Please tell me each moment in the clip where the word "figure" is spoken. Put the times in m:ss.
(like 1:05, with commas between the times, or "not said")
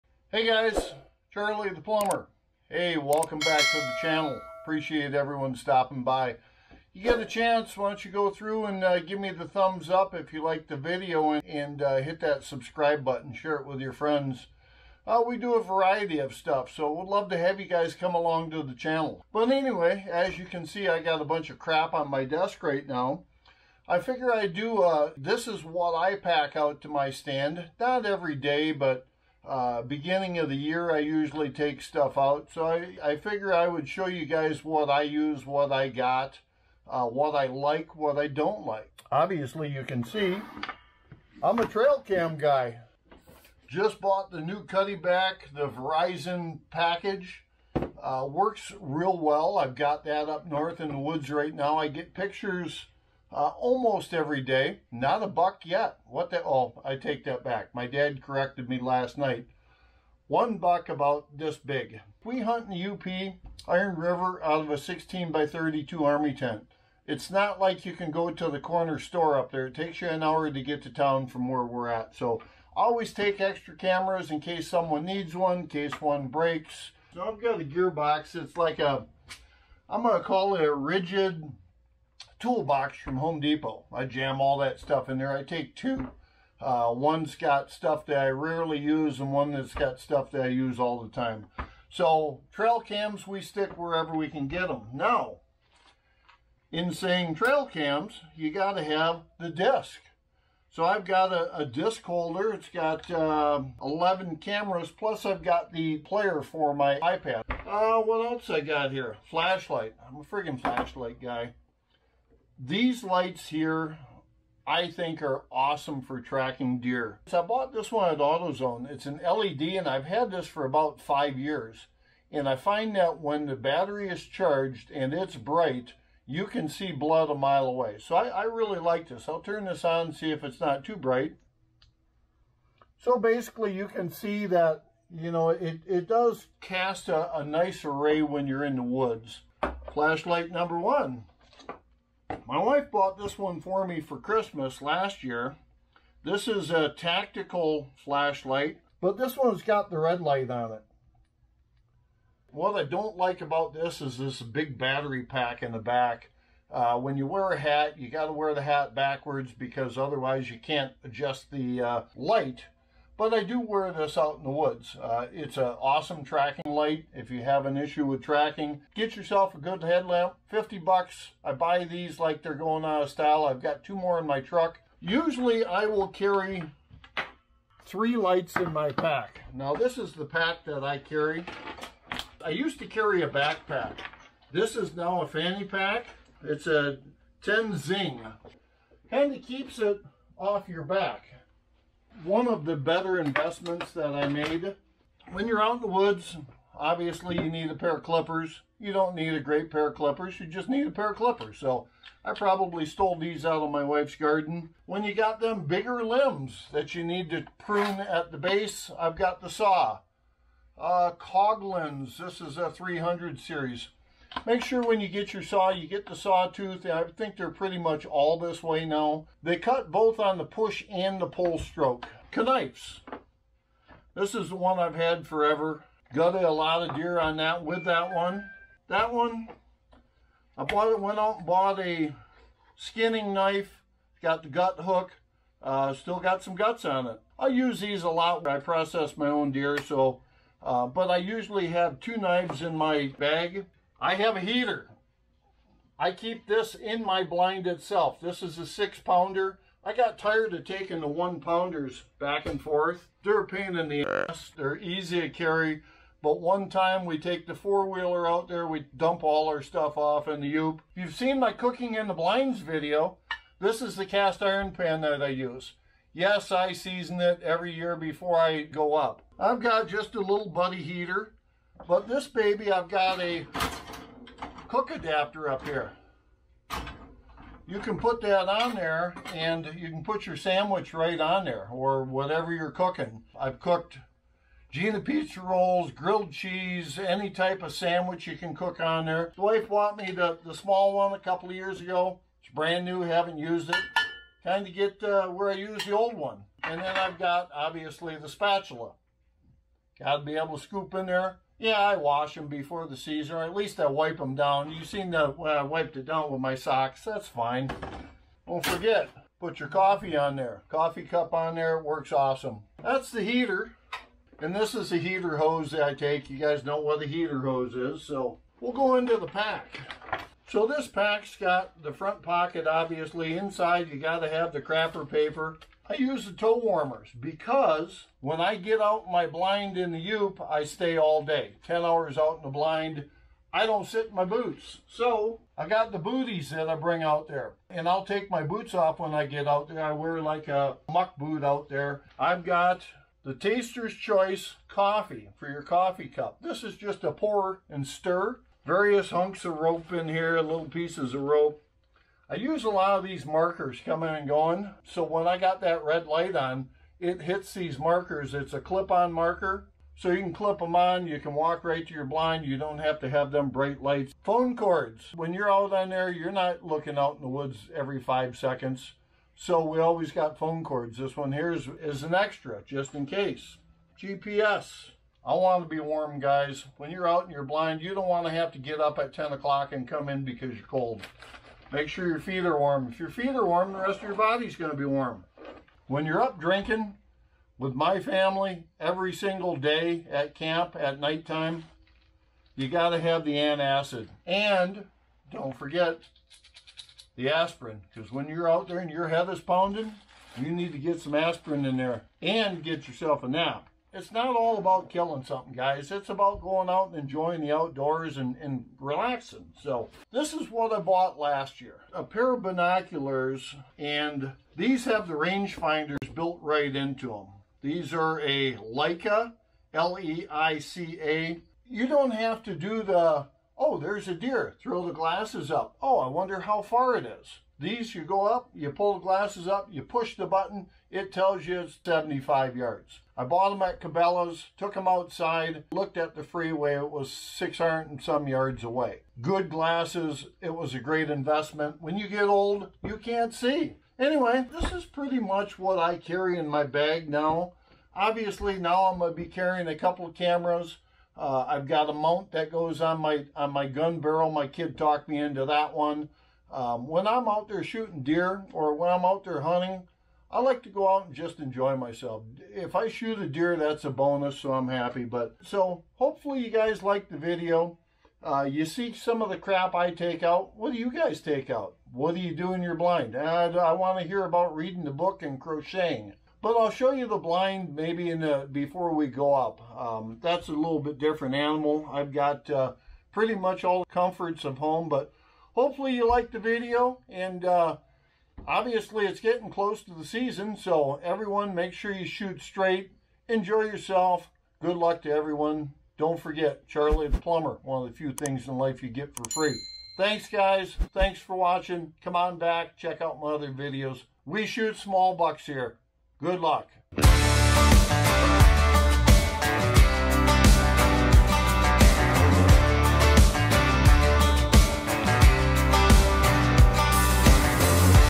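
0:23, 0:33.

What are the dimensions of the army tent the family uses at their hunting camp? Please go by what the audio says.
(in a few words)
16 by 32.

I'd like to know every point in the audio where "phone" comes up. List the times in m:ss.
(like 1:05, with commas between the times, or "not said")
6:04, 6:10.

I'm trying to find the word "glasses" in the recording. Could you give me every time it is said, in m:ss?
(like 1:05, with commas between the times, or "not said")
7:04, 7:09, 7:19.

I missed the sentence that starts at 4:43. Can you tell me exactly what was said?
I've cooked Gina pizza rolls, grilled cheese, any type of sandwich you can cook on there.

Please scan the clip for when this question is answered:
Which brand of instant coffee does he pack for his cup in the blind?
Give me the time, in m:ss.
5:43.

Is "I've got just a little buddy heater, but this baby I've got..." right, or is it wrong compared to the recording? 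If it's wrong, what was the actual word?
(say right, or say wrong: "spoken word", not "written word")
right.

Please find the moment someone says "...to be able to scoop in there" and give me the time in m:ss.
5:00.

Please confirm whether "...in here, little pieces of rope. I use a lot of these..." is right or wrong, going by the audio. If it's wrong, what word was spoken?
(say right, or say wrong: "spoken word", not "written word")
right.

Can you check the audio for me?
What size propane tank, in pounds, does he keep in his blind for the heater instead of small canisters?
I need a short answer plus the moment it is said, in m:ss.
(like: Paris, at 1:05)
6 pounds, at 4:08.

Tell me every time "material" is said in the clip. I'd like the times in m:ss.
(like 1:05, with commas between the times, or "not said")
not said.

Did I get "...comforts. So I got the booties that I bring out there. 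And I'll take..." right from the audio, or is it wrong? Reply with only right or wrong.
wrong.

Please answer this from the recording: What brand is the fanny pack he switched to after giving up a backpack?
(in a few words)
Tenzing.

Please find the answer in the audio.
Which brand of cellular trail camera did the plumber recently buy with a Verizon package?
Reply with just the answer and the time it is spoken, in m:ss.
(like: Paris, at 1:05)
Cuddeback, at 0:44.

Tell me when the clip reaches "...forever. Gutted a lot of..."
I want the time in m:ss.
3:45.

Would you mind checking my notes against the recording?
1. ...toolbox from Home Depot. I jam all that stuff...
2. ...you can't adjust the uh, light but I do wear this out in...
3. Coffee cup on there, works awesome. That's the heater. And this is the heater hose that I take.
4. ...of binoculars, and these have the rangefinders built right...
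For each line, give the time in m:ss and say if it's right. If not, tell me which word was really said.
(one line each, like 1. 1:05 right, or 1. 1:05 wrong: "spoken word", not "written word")
1. 1:22 right
2. 2:40 right
3. 5:10 right
4. 6:52 right.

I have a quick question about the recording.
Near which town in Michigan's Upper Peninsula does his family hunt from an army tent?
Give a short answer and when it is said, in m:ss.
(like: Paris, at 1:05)
Iron River, at 1:03.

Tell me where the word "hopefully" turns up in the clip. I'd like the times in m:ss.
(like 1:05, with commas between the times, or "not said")
7:45, 8:05.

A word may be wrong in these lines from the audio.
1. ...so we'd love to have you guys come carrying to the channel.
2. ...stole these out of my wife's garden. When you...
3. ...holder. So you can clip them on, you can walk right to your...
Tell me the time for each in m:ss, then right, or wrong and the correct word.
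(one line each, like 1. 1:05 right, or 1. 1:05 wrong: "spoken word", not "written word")
1. 0:16 wrong: "along", not "carrying"
2. 3:22 right
3. 5:59 wrong: "marker", not "holder".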